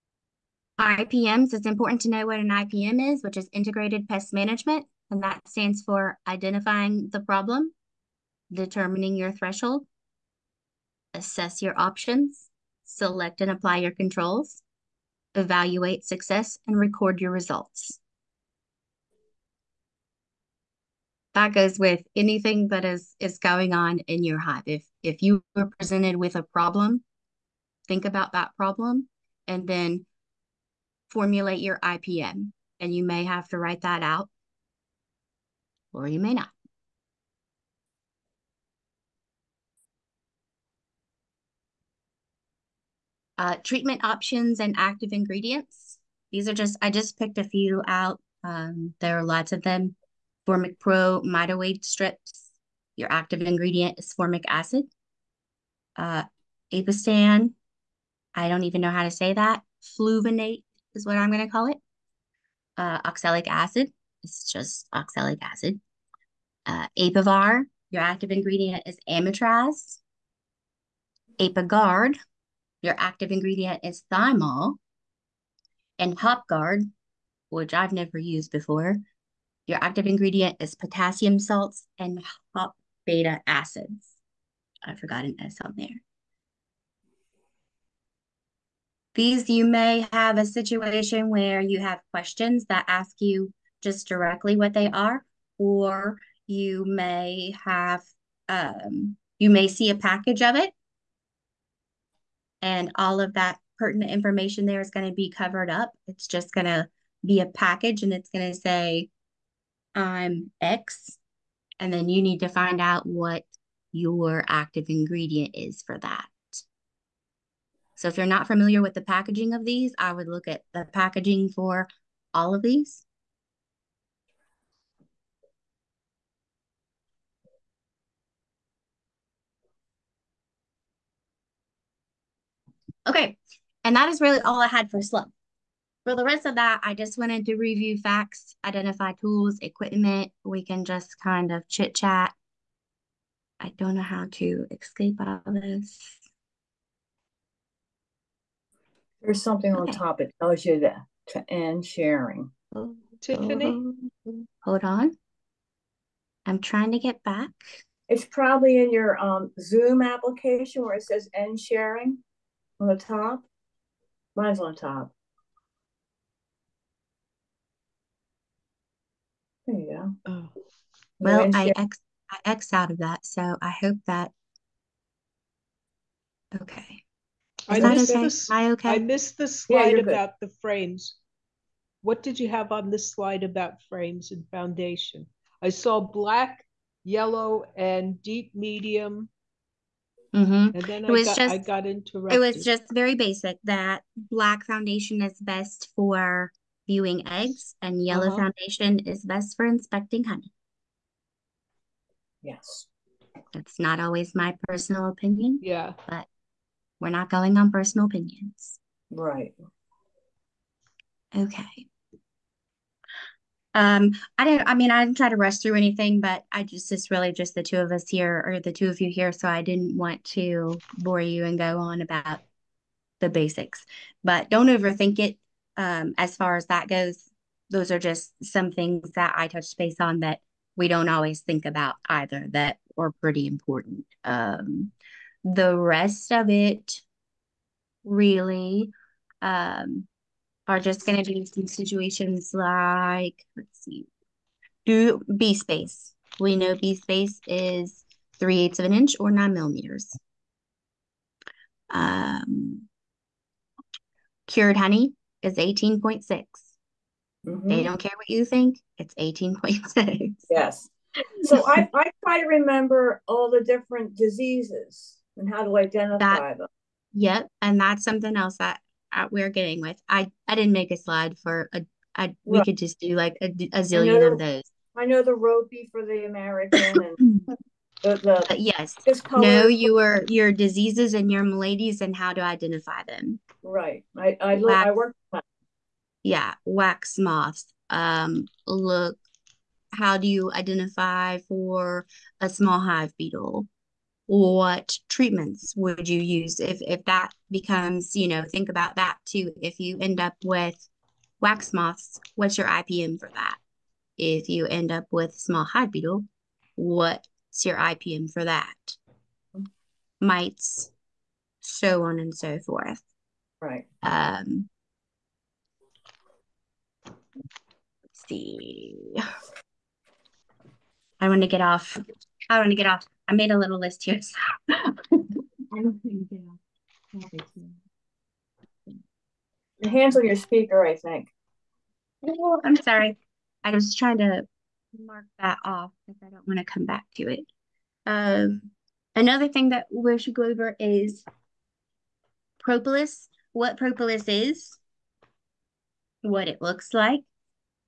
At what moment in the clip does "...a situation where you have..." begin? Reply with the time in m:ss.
1:30.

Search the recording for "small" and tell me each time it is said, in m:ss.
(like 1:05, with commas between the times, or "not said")
4:52, 5:05.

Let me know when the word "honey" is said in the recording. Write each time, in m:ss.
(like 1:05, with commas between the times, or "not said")
3:20, 4:14.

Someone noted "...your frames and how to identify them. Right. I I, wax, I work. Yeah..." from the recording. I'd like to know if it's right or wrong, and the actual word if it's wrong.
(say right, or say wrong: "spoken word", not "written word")
wrong: "maladies", not "frames".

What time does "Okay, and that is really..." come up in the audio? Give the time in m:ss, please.
2:13.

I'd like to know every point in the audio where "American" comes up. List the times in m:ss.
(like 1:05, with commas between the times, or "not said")
4:36.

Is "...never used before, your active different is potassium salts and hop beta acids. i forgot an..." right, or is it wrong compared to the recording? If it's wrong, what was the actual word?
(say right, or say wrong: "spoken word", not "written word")
wrong: "ingredient", not "different".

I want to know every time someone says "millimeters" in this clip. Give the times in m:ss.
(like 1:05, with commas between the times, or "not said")
4:09.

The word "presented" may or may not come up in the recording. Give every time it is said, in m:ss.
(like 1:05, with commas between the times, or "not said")
0:25.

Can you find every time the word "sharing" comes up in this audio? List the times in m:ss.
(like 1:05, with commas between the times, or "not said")
2:31, 2:41.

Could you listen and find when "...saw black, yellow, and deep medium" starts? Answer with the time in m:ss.
3:05.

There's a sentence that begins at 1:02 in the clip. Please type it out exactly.
Uh, oxalic acid, it's just oxalic acid.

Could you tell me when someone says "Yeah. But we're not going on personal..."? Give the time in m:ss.
3:25.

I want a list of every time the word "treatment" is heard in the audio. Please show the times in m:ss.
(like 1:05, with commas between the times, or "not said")
0:43, 4:55.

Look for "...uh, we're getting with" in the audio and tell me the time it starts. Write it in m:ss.
4:29.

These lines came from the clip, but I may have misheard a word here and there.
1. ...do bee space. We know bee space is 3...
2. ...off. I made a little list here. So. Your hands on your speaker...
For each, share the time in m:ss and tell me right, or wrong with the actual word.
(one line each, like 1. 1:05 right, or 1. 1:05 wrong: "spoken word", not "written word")
1. 4:04 right
2. 5:22 right.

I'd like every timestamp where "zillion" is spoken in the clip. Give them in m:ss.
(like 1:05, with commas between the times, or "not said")
4:33.